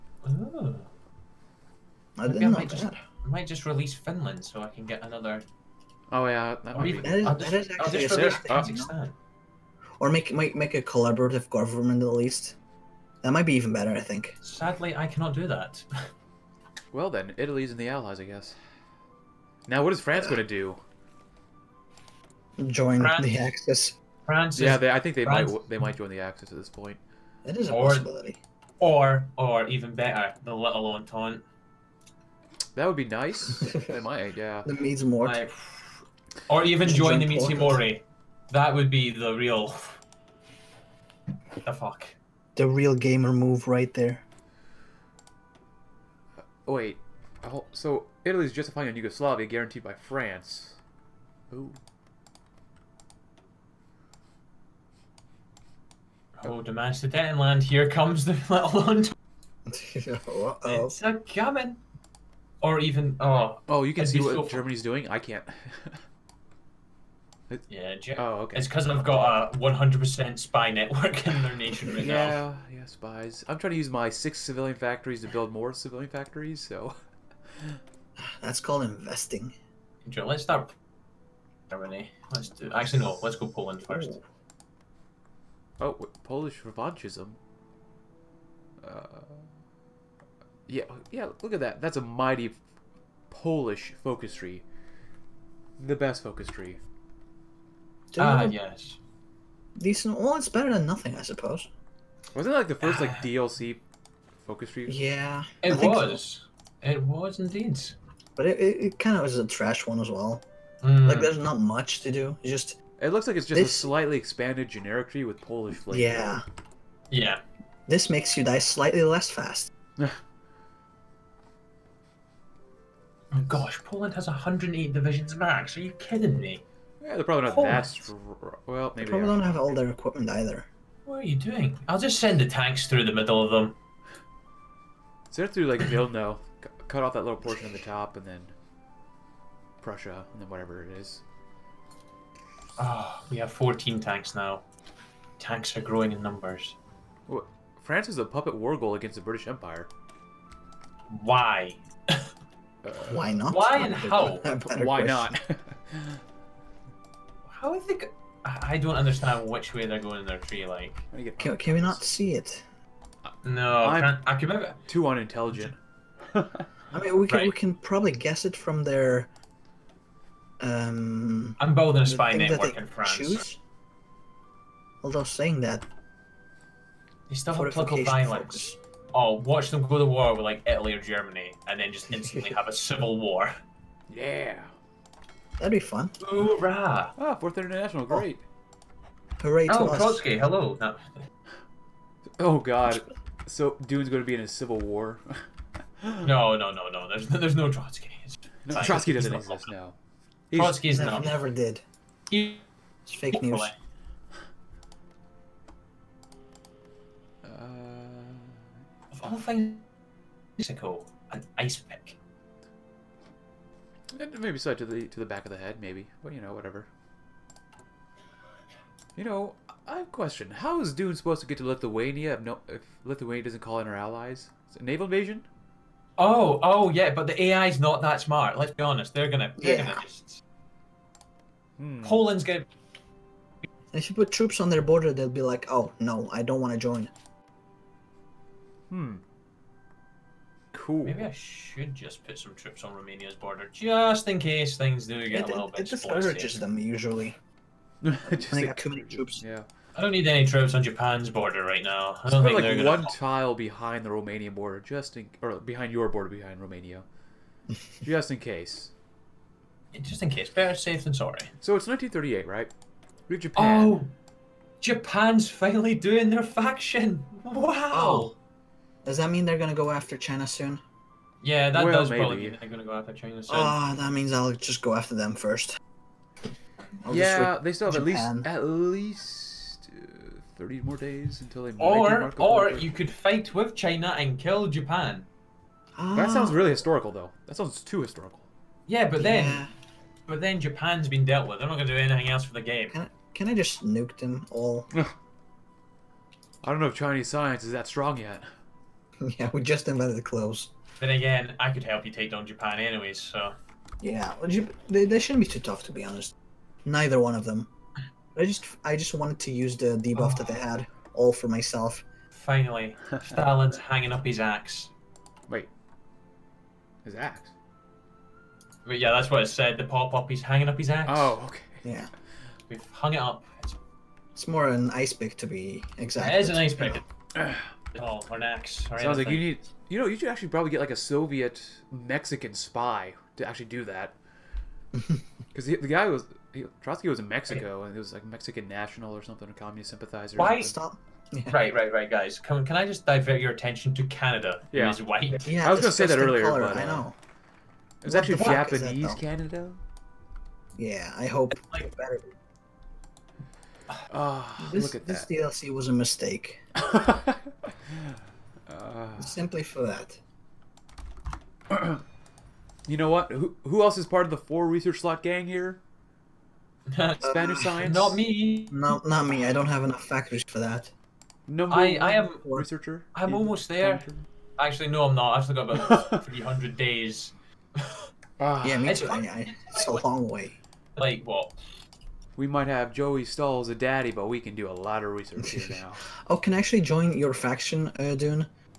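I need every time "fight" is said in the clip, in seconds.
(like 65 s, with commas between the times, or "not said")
283 s.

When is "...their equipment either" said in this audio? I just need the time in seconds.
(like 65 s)
129 s.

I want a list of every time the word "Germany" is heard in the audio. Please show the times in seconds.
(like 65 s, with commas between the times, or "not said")
64 s, 81 s, 181 s.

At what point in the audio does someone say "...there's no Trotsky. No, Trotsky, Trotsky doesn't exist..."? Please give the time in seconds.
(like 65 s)
197 s.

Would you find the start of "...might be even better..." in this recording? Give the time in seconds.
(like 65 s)
13 s.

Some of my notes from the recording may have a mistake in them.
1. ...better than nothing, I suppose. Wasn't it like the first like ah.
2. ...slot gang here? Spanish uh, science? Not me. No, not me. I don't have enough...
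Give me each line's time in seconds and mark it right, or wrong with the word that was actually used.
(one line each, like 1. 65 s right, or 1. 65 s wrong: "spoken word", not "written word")
1. 100 s right
2. 364 s right.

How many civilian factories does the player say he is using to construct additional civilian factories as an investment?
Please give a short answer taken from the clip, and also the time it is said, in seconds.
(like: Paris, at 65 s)
6, at 74 s.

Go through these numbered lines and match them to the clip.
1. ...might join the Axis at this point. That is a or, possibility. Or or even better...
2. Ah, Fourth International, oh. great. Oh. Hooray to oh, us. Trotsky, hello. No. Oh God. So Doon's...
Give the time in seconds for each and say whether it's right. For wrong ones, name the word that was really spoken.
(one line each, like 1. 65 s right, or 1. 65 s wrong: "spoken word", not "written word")
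1. 25 s right
2. 187 s right.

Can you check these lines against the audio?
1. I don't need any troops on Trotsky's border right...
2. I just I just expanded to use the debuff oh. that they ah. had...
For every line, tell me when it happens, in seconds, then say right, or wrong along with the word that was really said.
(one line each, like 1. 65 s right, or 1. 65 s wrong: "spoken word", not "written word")
1. 249 s wrong: "Japan", not "Trotsky"
2. 308 s wrong: "wanted", not "expanded".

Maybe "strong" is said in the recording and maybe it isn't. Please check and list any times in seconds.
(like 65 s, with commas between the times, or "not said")
127 s, 297 s.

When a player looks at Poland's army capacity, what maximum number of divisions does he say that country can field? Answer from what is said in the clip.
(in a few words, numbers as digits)
108.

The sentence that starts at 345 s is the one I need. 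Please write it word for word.
Yeah, I was gonna say that earlier, color, but uh, I know.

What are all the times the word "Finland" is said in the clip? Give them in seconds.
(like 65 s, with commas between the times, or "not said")
3 s.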